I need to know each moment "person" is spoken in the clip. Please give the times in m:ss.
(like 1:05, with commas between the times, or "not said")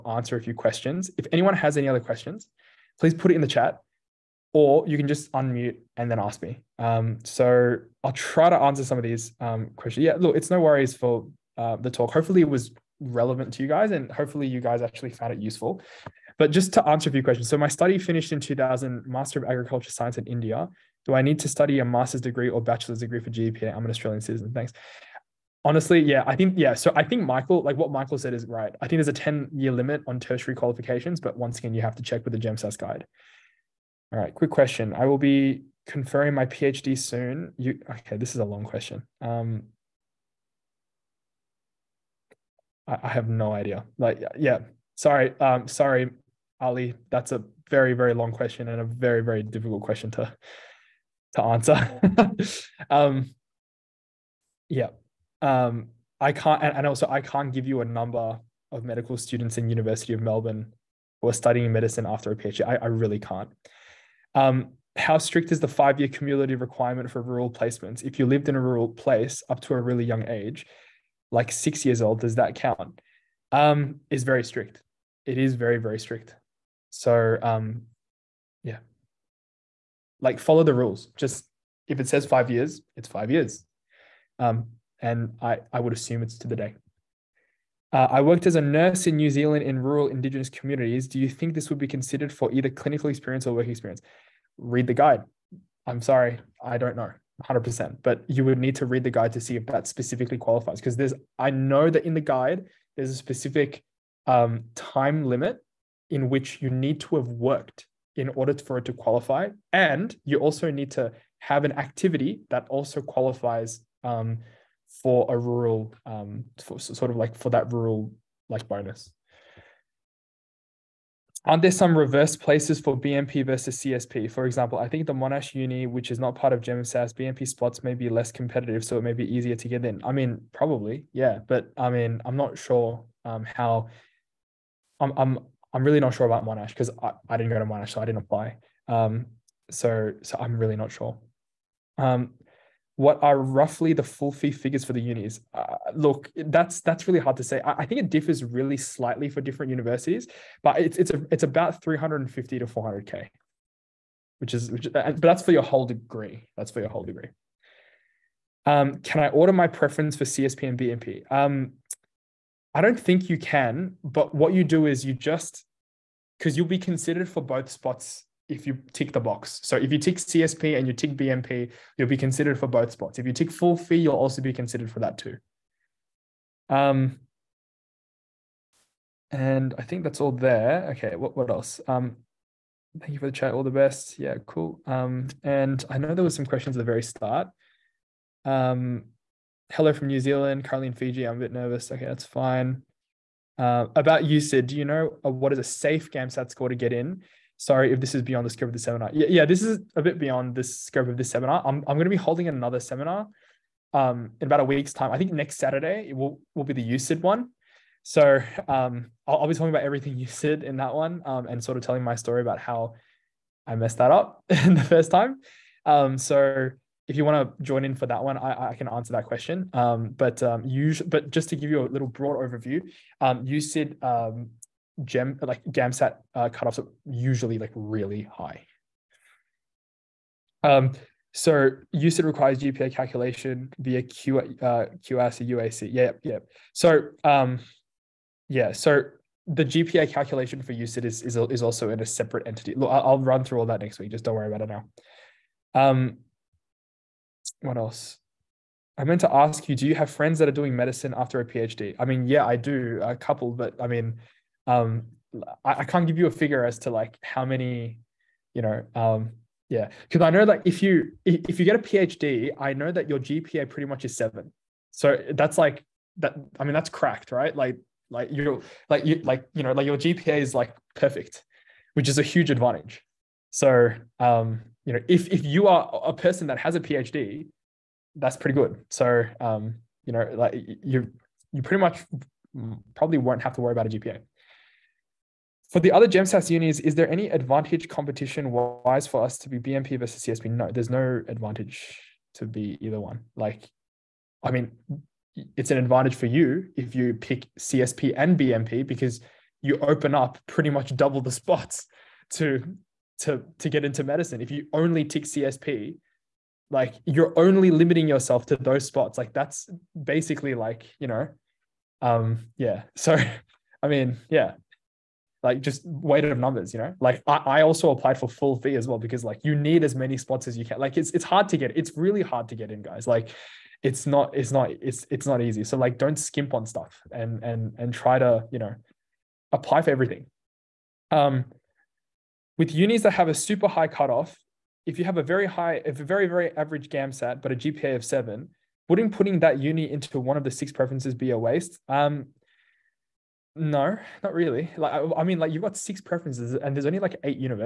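4:36.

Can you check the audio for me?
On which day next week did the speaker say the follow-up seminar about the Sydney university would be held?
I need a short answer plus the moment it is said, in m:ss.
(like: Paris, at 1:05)
Saturday, at 3:25.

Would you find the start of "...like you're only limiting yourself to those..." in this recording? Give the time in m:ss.
5:06.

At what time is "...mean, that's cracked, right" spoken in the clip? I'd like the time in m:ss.
4:26.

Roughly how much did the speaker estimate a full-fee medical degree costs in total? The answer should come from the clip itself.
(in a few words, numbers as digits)
350 to 400k.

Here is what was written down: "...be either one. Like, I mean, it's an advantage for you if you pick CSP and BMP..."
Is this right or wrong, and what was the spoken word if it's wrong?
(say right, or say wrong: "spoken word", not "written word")
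right.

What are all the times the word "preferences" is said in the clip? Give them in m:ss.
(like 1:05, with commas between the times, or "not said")
2:39, 5:40, 5:46.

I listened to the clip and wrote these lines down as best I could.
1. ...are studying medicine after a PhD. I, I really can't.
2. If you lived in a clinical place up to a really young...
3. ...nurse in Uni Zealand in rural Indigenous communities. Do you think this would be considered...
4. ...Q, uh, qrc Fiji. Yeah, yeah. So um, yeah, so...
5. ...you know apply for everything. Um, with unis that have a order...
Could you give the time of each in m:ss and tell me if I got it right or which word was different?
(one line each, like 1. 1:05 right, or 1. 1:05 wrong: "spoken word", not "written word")
1. 1:01 right
2. 1:08 wrong: "rural", not "clinical"
3. 1:28 wrong: "New", not "Uni"
4. 3:54 wrong: "UAC", not "Fiji"
5. 5:28 wrong: "super", not "order".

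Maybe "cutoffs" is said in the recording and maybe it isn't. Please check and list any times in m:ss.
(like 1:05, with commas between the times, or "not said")
3:46, 5:33.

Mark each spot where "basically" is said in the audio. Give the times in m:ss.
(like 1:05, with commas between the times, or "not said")
5:10.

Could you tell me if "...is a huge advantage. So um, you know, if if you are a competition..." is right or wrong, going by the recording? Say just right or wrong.
wrong.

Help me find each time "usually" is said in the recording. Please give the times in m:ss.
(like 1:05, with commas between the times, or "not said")
3:40, 3:47.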